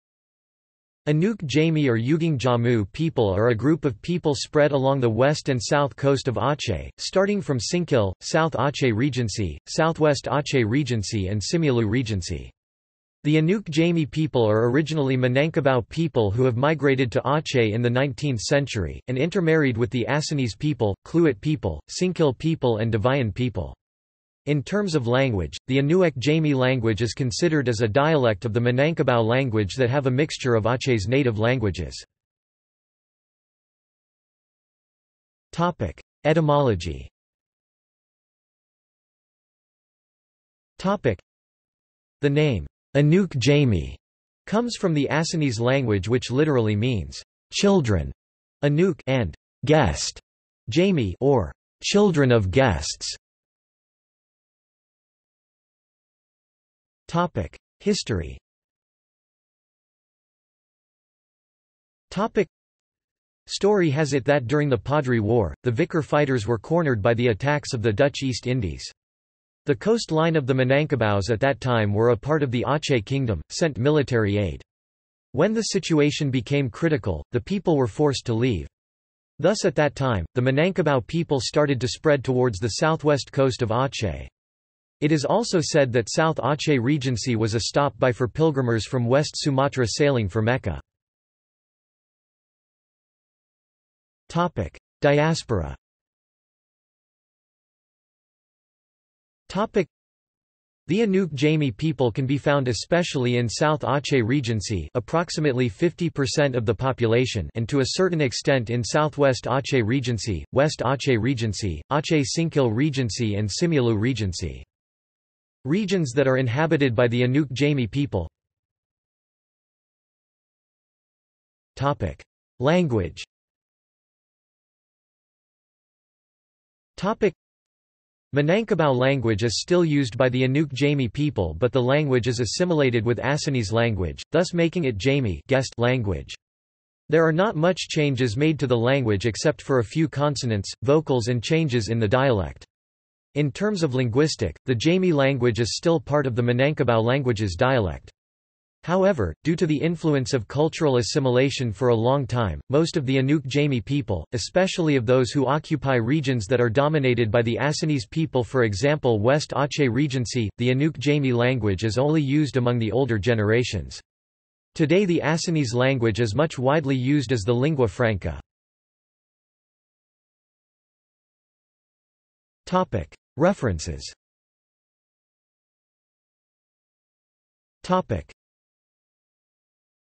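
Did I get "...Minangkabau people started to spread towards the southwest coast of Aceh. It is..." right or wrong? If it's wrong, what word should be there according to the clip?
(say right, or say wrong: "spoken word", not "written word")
right.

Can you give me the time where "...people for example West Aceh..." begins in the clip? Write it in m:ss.
2:38.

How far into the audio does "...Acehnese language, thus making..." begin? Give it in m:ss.
2:13.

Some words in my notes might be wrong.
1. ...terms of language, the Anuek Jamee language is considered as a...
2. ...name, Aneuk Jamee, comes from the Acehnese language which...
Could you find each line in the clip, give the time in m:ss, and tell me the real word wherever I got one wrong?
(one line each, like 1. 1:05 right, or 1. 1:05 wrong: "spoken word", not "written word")
1. 0:24 right
2. 0:42 right.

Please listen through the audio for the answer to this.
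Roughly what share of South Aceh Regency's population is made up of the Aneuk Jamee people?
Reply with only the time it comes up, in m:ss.
1:45.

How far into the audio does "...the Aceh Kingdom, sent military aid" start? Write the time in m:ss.
1:12.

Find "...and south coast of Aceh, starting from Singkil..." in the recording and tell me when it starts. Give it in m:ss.
0:05.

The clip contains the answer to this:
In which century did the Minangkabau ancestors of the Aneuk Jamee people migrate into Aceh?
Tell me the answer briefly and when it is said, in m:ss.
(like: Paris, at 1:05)
19th century, at 0:17.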